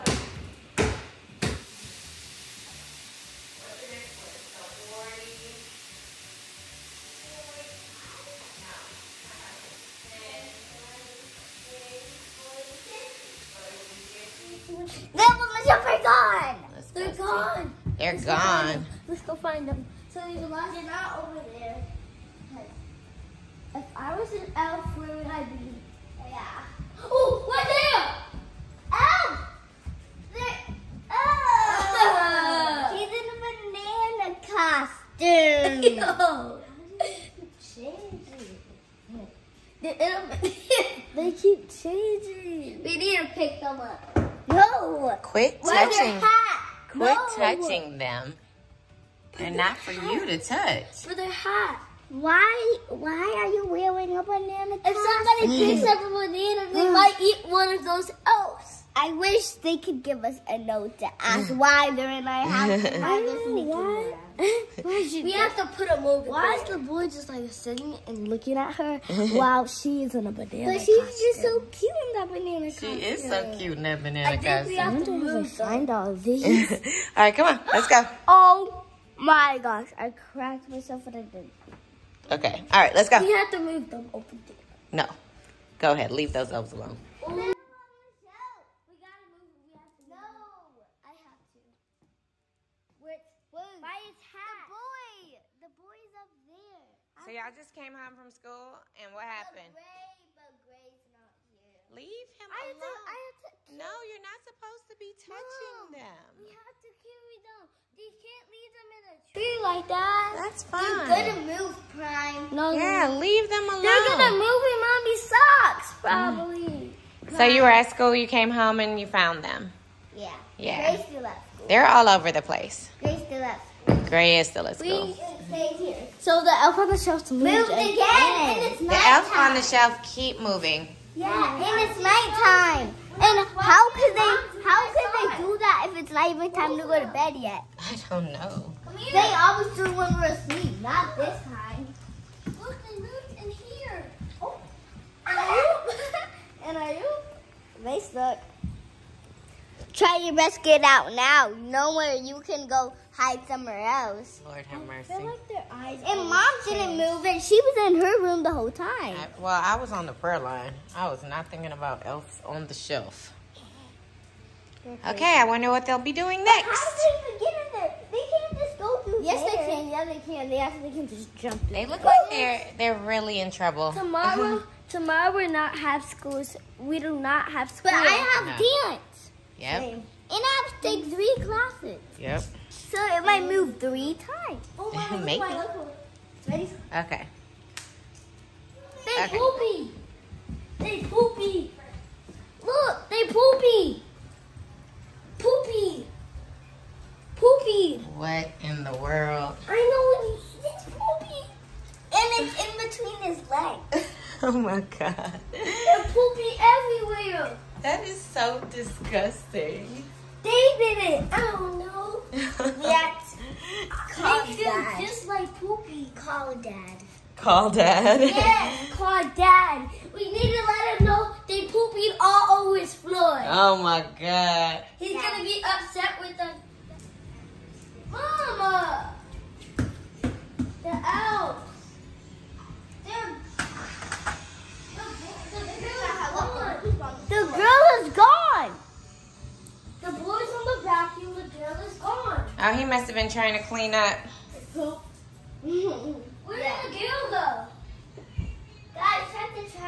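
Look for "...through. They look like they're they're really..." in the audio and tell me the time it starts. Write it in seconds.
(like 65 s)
171 s.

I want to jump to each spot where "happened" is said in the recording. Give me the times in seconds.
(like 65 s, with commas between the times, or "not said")
99 s.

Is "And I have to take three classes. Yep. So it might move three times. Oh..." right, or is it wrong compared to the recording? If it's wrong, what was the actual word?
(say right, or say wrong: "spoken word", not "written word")
right.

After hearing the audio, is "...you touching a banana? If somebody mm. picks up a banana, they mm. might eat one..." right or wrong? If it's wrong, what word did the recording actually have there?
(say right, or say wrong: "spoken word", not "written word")
wrong: "wearing", not "touching".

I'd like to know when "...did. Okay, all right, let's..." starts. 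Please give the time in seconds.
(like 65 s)
81 s.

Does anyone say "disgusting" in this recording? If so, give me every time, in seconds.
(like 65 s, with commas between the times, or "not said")
208 s.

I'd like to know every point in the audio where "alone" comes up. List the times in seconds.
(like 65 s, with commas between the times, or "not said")
86 s, 102 s, 113 s.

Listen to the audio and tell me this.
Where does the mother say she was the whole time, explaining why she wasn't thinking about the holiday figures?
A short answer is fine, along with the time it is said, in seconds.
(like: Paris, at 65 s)
the prayer line, at 160 s.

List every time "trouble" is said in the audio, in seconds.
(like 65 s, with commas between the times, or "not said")
173 s.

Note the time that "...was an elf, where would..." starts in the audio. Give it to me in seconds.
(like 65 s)
24 s.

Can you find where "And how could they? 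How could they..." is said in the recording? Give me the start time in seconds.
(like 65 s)
133 s.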